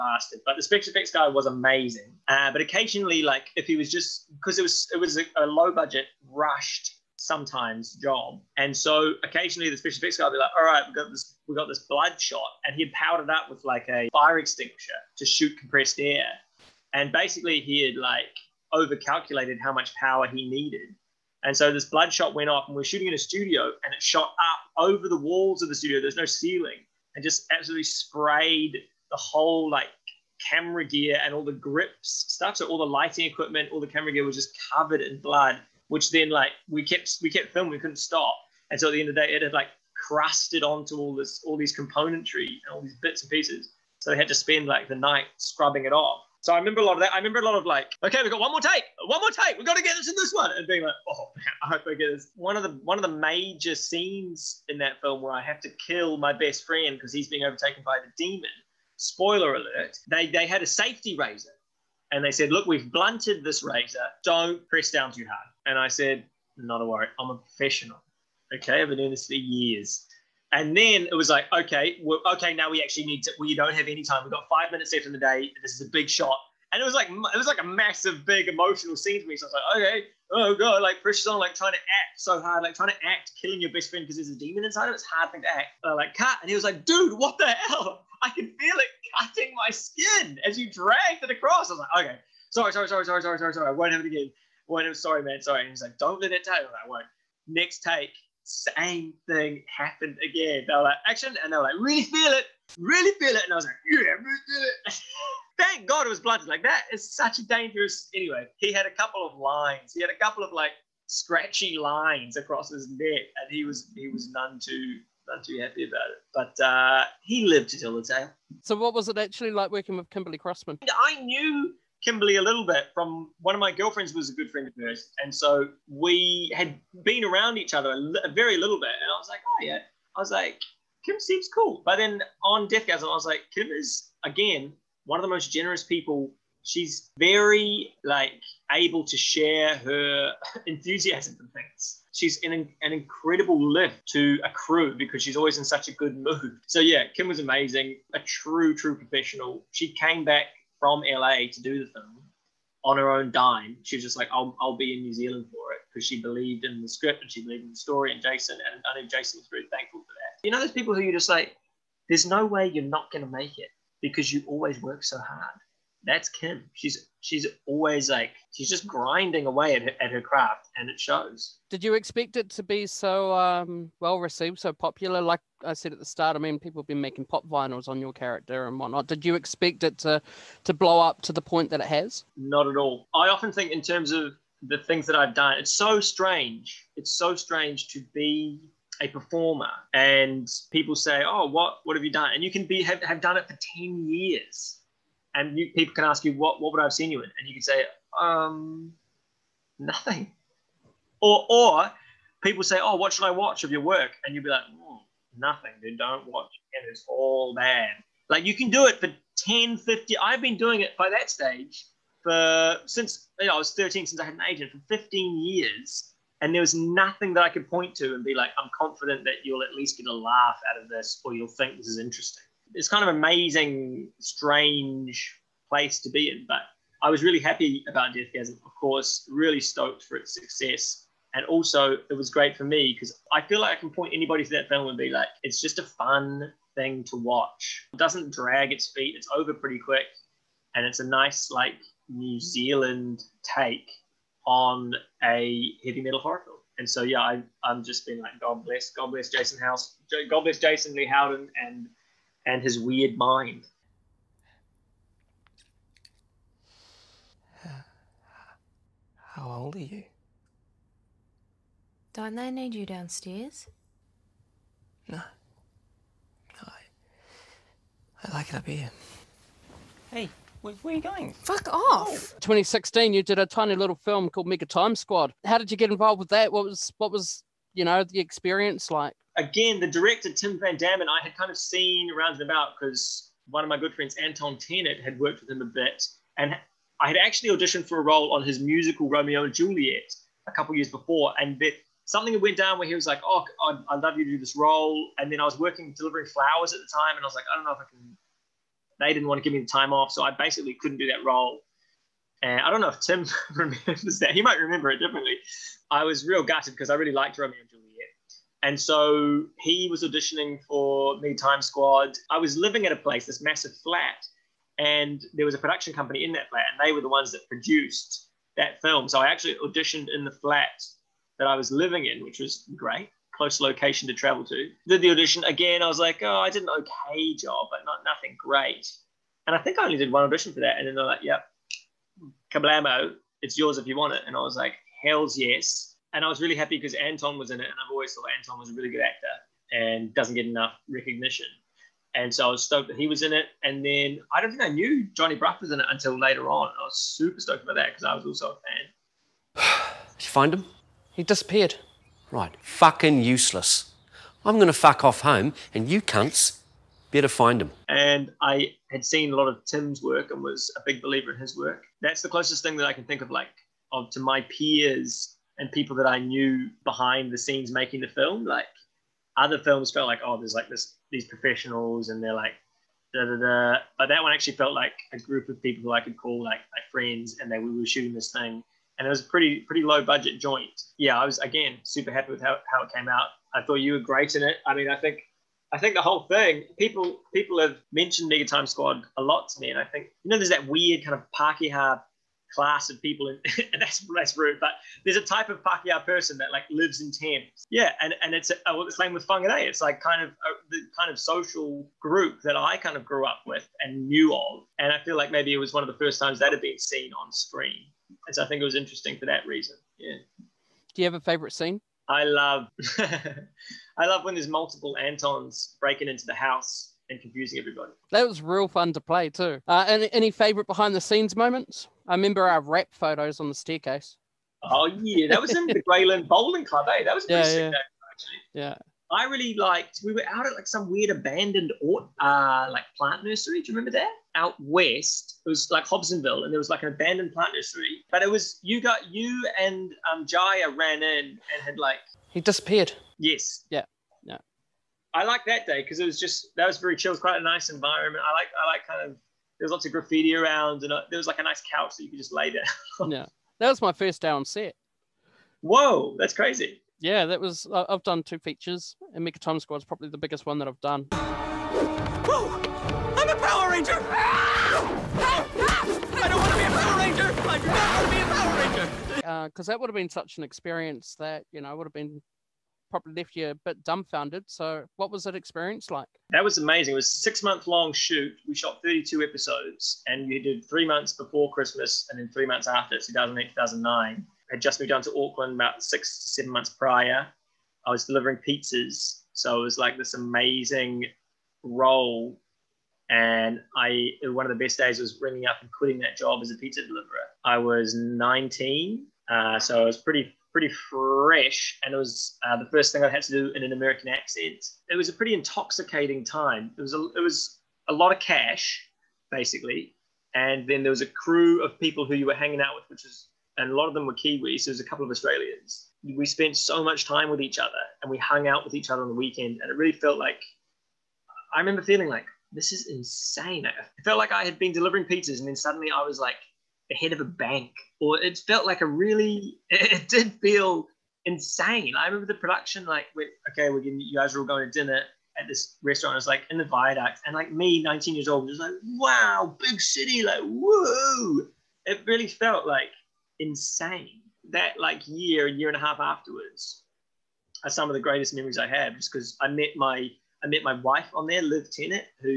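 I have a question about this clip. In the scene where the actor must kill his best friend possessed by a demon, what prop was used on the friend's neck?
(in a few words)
Safety razor.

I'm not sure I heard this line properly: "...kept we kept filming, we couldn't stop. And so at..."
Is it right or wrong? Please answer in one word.
right.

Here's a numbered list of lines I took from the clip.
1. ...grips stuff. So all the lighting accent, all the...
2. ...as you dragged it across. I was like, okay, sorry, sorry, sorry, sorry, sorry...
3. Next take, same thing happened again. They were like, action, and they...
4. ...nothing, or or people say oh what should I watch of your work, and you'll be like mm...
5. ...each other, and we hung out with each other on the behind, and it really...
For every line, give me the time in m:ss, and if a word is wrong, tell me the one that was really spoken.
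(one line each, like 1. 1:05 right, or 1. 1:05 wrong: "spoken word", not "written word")
1. 0:31 wrong: "equipment", not "accent"
2. 1:30 right
3. 1:37 right
4. 3:19 right
5. 8:37 wrong: "weekend", not "behind".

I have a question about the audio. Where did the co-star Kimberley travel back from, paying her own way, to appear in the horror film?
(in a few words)
LA.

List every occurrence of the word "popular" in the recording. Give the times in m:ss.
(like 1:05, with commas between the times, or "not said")
2:54.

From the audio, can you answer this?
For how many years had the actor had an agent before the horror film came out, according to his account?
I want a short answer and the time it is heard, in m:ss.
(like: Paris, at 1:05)
15, at 3:34.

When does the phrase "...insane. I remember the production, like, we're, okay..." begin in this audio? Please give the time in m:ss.
8:51.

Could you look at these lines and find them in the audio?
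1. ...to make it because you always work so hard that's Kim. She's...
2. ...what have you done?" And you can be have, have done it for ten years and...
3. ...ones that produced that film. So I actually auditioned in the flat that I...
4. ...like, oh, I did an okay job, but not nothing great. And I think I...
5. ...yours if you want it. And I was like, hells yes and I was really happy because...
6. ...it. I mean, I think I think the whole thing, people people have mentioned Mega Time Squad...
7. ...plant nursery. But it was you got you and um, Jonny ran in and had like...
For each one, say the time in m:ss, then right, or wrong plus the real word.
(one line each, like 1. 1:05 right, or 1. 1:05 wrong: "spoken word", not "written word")
1. 2:43 right
2. 3:11 right
3. 5:17 right
4. 5:25 right
5. 5:33 right
6. 6:24 right
7. 7:17 wrong: "Jaya", not "Jonny".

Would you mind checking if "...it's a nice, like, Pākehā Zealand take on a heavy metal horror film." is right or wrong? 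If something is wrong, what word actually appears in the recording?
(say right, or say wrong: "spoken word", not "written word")
wrong: "New", not "Pākehā".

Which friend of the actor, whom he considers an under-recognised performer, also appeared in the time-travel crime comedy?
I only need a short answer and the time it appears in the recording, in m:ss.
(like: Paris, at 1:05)
Anton Tennet, at 4:44.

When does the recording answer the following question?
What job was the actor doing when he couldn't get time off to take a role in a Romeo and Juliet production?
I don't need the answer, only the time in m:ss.
4:55.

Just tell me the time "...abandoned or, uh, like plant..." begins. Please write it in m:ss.
7:11.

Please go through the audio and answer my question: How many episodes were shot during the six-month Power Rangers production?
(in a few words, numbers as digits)
32.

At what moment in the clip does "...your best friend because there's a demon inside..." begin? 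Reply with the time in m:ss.
1:23.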